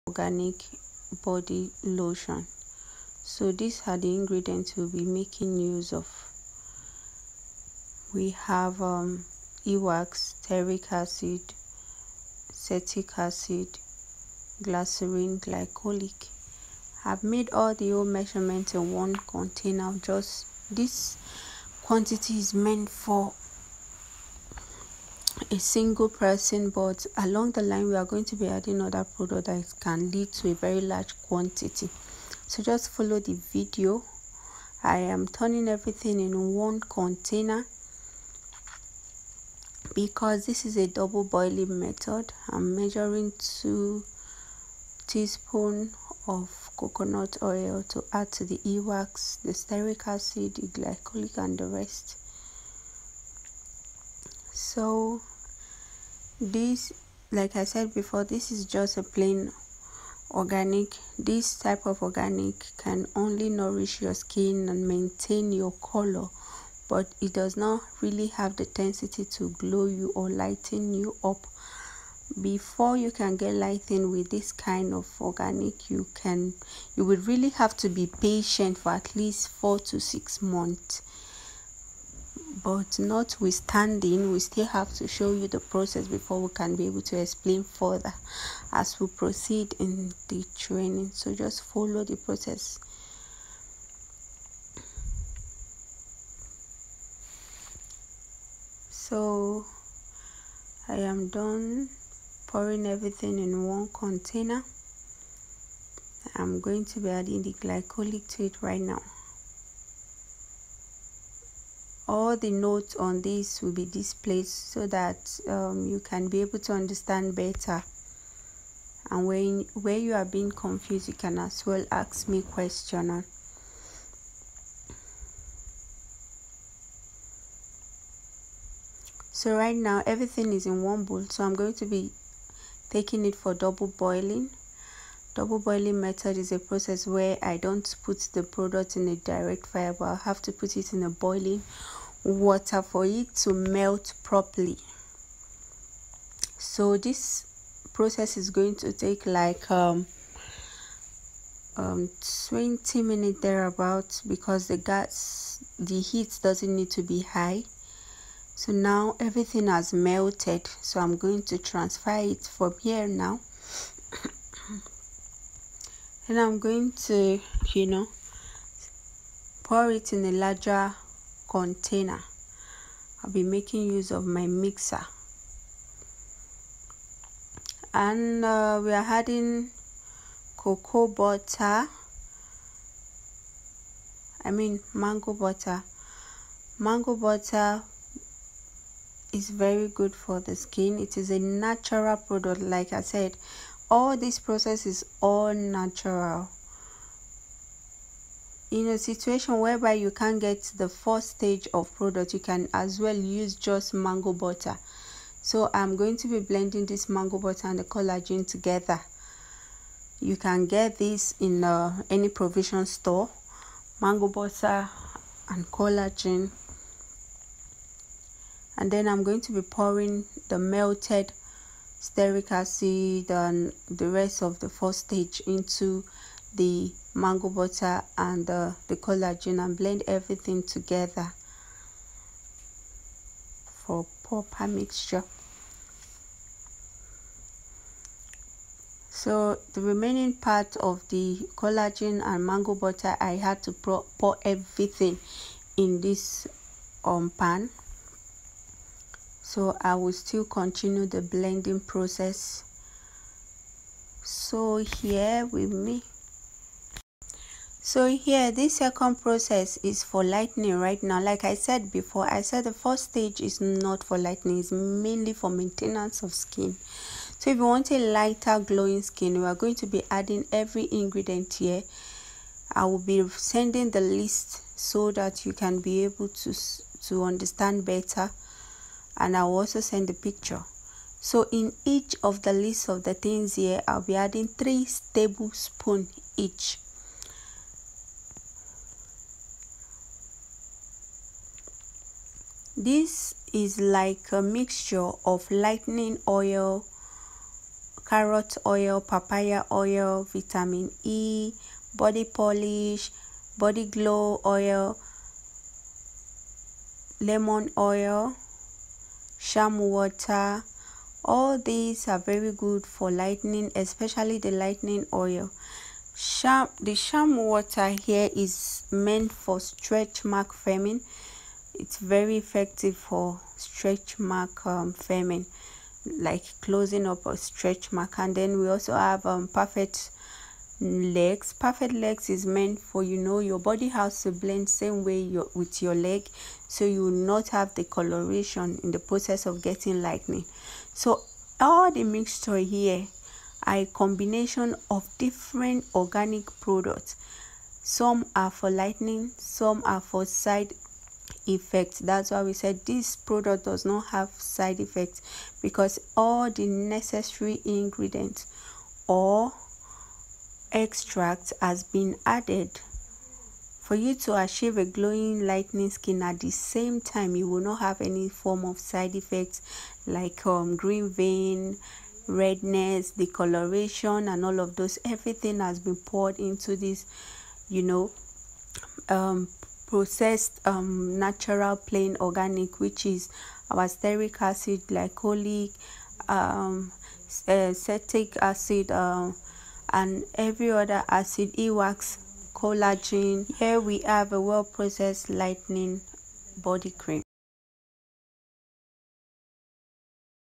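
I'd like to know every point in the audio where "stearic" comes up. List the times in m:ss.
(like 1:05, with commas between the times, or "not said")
0:10, 0:49, 3:41, 6:23.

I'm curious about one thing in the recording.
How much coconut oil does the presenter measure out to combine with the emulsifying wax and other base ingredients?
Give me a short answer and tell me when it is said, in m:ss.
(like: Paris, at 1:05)
2 teaspoons, at 0:43.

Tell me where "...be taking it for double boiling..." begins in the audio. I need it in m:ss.
2:11.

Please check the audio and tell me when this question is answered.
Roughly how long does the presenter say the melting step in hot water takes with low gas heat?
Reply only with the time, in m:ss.
2:32.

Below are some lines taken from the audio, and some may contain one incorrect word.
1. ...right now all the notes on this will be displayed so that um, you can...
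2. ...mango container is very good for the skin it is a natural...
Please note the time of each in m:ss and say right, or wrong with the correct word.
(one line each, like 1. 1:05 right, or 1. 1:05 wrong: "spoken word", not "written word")
1. 1:48 right
2. 3:06 wrong: "butter", not "container".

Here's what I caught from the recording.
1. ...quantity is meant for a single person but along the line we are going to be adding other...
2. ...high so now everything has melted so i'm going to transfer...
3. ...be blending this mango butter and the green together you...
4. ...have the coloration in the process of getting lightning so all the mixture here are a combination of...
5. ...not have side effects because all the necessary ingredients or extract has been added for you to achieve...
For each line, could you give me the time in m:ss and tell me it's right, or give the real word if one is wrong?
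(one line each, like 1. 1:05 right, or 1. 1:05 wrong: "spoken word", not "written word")
1. 0:21 right
2. 2:37 right
3. 3:26 wrong: "collagen", not "green"
4. 5:37 right
5. 5:53 right.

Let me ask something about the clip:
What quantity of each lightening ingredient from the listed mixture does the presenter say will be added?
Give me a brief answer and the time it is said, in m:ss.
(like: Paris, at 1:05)
3 tablespoons, at 4:44.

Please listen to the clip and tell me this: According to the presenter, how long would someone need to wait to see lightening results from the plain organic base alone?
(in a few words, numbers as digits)
4 to 6 months.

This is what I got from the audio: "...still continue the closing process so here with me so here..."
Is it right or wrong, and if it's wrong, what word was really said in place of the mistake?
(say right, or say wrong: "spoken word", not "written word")
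wrong: "blending", not "closing".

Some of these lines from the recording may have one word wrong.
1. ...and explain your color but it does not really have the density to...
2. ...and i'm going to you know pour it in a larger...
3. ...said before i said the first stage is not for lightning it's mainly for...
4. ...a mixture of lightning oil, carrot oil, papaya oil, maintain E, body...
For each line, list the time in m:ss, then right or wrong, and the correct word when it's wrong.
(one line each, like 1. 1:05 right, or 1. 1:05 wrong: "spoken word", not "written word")
1. 1:04 wrong: "maintain", not "explain"
2. 2:46 right
3. 4:21 right
4. 4:54 wrong: "vitamin", not "maintain".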